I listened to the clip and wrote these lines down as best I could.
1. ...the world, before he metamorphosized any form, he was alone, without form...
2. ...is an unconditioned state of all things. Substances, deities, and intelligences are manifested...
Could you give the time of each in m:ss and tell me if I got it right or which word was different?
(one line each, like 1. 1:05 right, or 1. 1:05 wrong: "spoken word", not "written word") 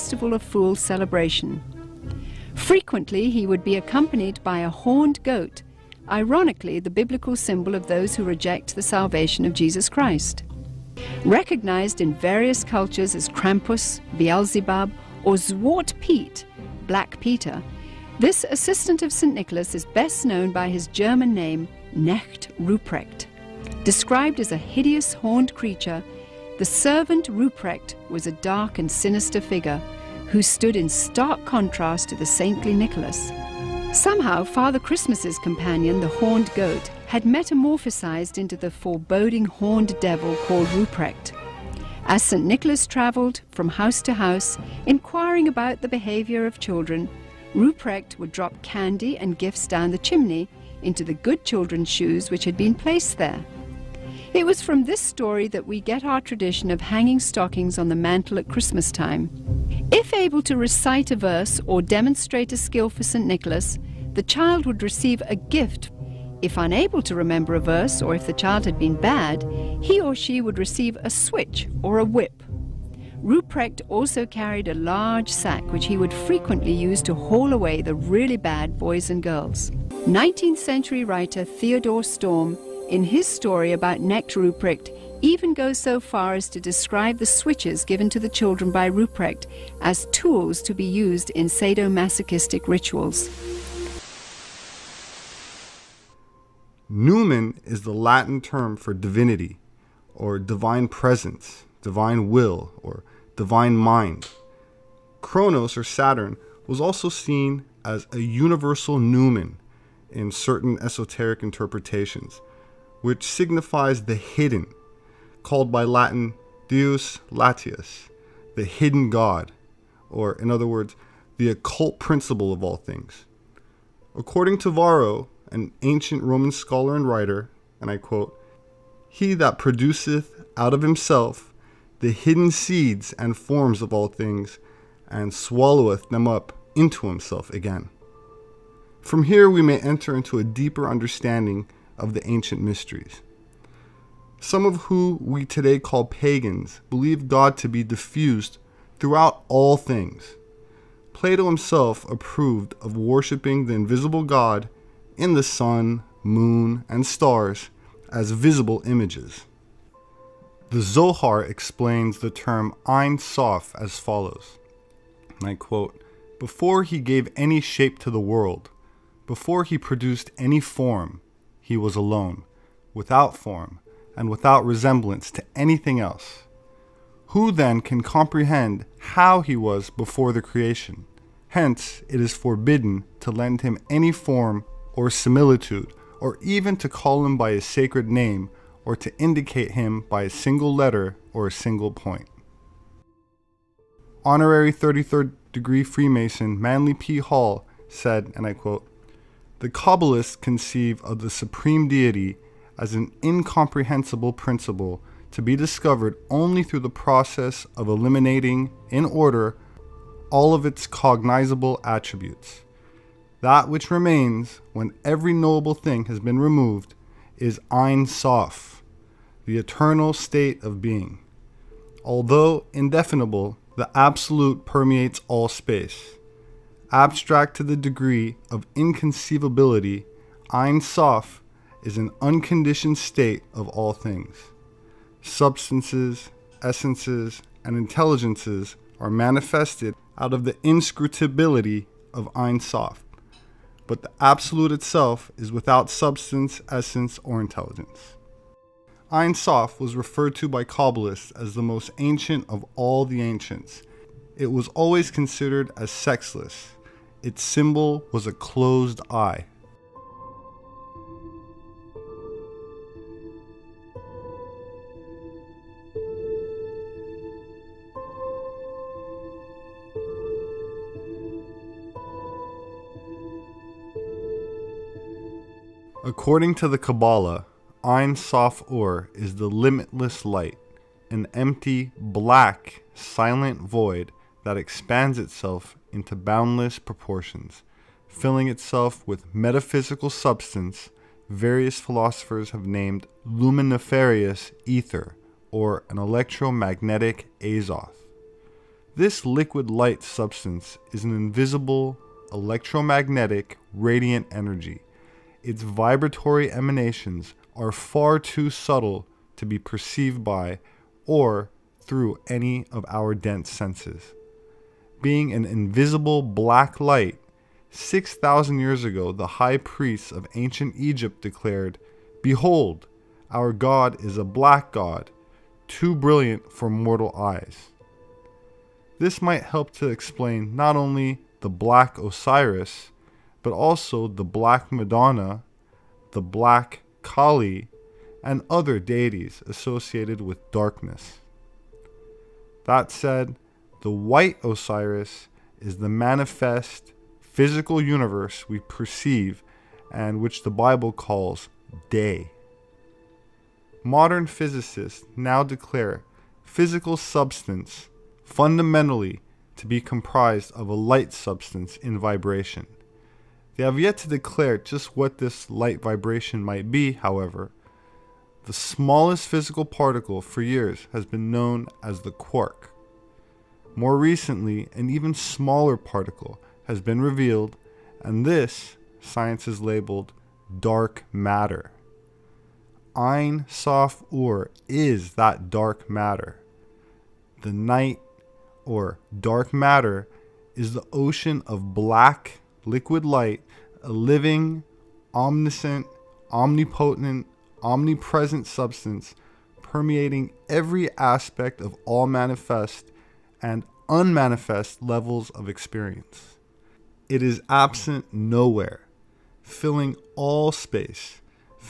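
1. 2:48 wrong: "produced", not "metamorphosized"
2. 3:51 wrong: "essences", not "deities".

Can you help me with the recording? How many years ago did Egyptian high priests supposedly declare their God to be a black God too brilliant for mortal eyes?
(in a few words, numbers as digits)
6,000.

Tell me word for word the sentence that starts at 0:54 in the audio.
It was from this story that we get our tradition of hanging stockings on the mantle at Christmas time.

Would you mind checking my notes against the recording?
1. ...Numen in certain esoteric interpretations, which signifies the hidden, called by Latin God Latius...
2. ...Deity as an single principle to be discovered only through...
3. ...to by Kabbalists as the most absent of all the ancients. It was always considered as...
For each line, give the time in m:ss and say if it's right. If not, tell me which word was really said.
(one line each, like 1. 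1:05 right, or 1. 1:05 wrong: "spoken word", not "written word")
1. 1:48 wrong: "Deus", not "God"
2. 3:21 wrong: "incomprehensible", not "single"
3. 4:10 wrong: "ancient", not "absent".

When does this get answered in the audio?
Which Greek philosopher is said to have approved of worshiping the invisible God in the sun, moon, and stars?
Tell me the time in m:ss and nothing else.
2:31.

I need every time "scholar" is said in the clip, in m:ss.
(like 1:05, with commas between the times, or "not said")
2:06.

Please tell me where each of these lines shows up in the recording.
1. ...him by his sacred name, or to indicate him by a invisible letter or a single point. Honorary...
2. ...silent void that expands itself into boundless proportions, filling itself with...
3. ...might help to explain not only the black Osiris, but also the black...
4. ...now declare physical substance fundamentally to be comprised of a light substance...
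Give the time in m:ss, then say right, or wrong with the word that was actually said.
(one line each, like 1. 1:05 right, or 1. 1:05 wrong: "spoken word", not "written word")
1. 3:07 wrong: "single", not "invisible"
2. 4:42 right
3. 5:29 right
4. 5:55 right.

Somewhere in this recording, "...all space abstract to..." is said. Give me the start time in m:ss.
3:45.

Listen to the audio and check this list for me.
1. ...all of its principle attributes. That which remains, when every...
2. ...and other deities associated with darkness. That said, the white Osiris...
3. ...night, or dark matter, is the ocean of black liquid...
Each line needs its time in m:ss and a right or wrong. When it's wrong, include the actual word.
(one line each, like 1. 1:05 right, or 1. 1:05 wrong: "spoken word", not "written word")
1. 3:30 wrong: "cognizable", not "principle"
2. 5:38 right
3. 6:27 right.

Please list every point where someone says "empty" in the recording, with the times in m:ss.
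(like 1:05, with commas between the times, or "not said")
4:41.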